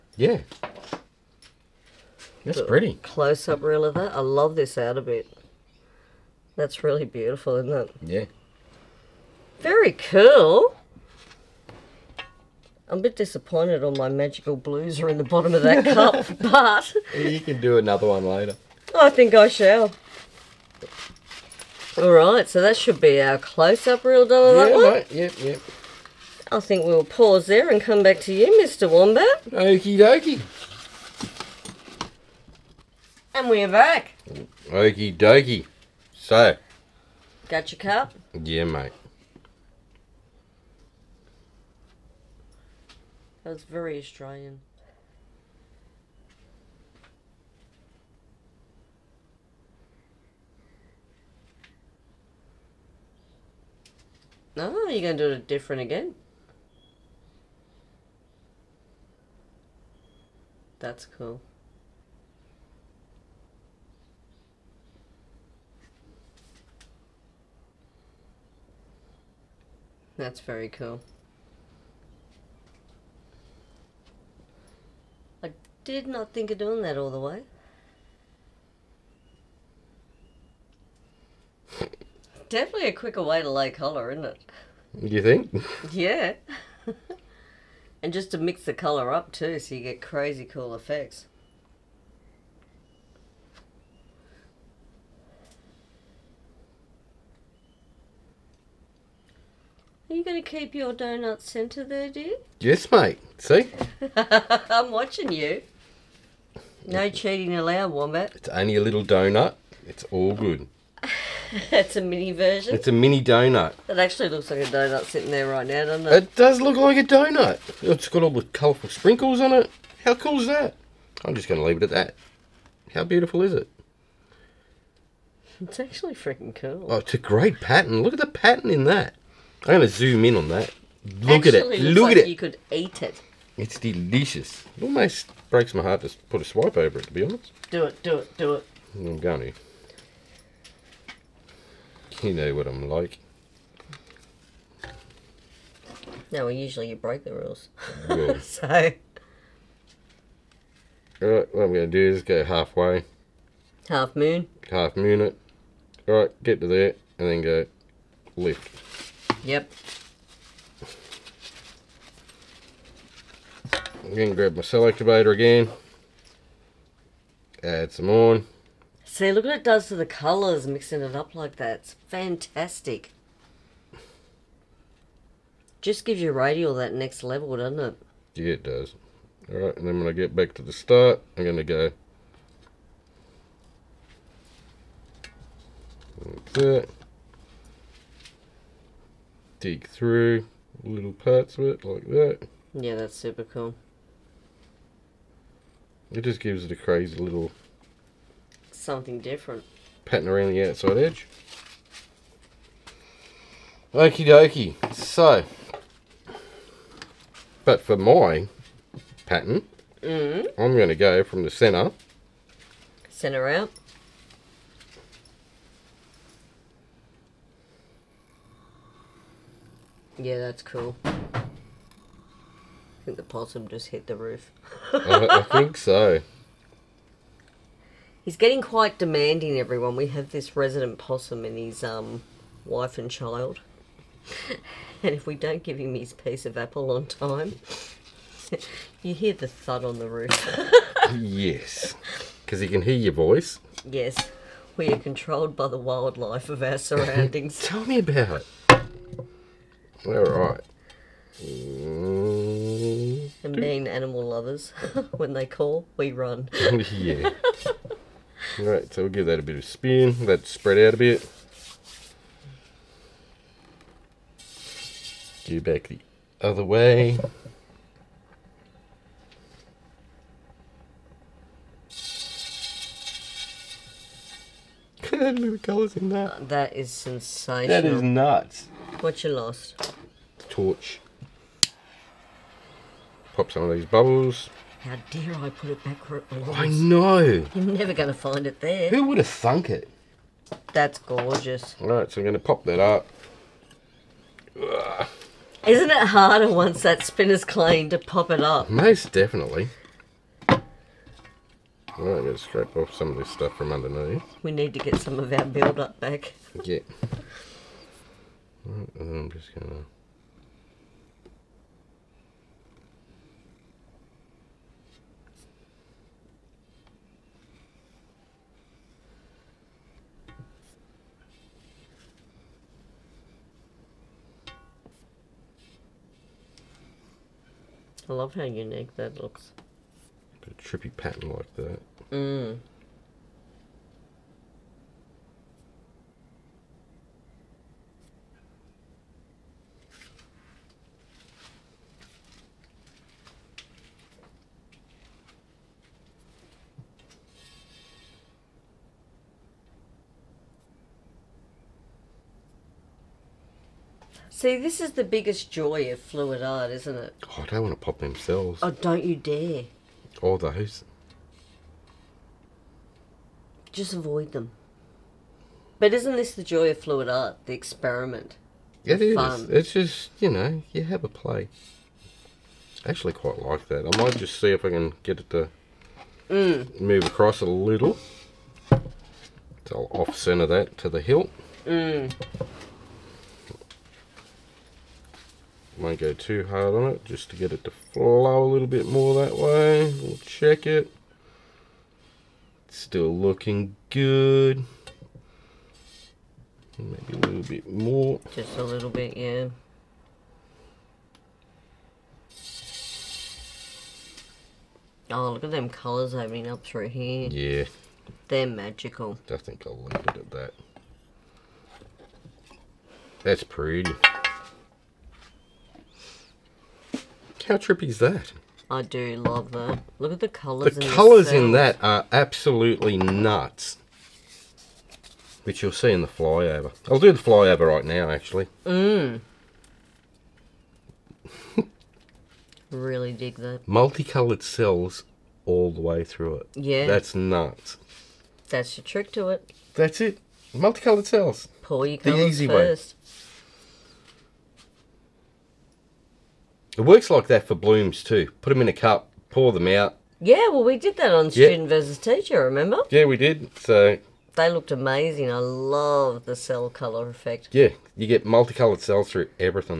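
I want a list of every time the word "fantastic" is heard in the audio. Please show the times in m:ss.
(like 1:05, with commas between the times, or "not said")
2:52.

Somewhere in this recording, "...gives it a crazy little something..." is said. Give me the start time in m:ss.
3:16.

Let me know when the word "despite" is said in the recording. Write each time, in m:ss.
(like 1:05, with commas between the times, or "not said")
not said.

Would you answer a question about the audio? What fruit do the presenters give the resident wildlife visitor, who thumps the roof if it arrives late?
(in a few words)
Apple.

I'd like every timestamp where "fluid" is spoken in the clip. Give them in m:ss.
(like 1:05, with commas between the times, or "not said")
5:55, 6:06.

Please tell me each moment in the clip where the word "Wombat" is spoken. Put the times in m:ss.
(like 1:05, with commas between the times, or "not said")
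0:28, 1:47.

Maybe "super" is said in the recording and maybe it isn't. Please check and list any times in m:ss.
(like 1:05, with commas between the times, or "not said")
3:13.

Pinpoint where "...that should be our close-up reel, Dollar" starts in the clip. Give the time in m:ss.
0:22.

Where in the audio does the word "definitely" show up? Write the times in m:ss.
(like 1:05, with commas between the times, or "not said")
1:22, 4:59.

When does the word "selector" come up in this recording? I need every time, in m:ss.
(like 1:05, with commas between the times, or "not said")
2:44.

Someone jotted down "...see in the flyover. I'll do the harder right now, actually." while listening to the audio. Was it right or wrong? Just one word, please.
wrong.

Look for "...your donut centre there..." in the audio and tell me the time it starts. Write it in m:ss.
1:40.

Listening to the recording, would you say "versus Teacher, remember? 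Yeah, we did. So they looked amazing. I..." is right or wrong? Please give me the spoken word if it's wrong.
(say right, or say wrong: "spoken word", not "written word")
right.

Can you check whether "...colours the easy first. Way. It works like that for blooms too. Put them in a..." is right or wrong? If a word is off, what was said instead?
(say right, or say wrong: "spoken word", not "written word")
right.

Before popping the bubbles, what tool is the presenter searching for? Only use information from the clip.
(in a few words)
Torch.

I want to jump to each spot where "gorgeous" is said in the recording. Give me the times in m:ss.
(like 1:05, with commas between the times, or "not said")
4:50.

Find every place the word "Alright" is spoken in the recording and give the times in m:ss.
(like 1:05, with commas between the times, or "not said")
2:36, 2:59.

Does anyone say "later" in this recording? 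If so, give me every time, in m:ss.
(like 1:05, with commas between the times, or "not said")
0:18.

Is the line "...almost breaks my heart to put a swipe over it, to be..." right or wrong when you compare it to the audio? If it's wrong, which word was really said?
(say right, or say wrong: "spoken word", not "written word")
right.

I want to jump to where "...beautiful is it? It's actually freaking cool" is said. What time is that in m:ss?
2:03.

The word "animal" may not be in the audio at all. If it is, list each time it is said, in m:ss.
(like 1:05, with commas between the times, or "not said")
4:13.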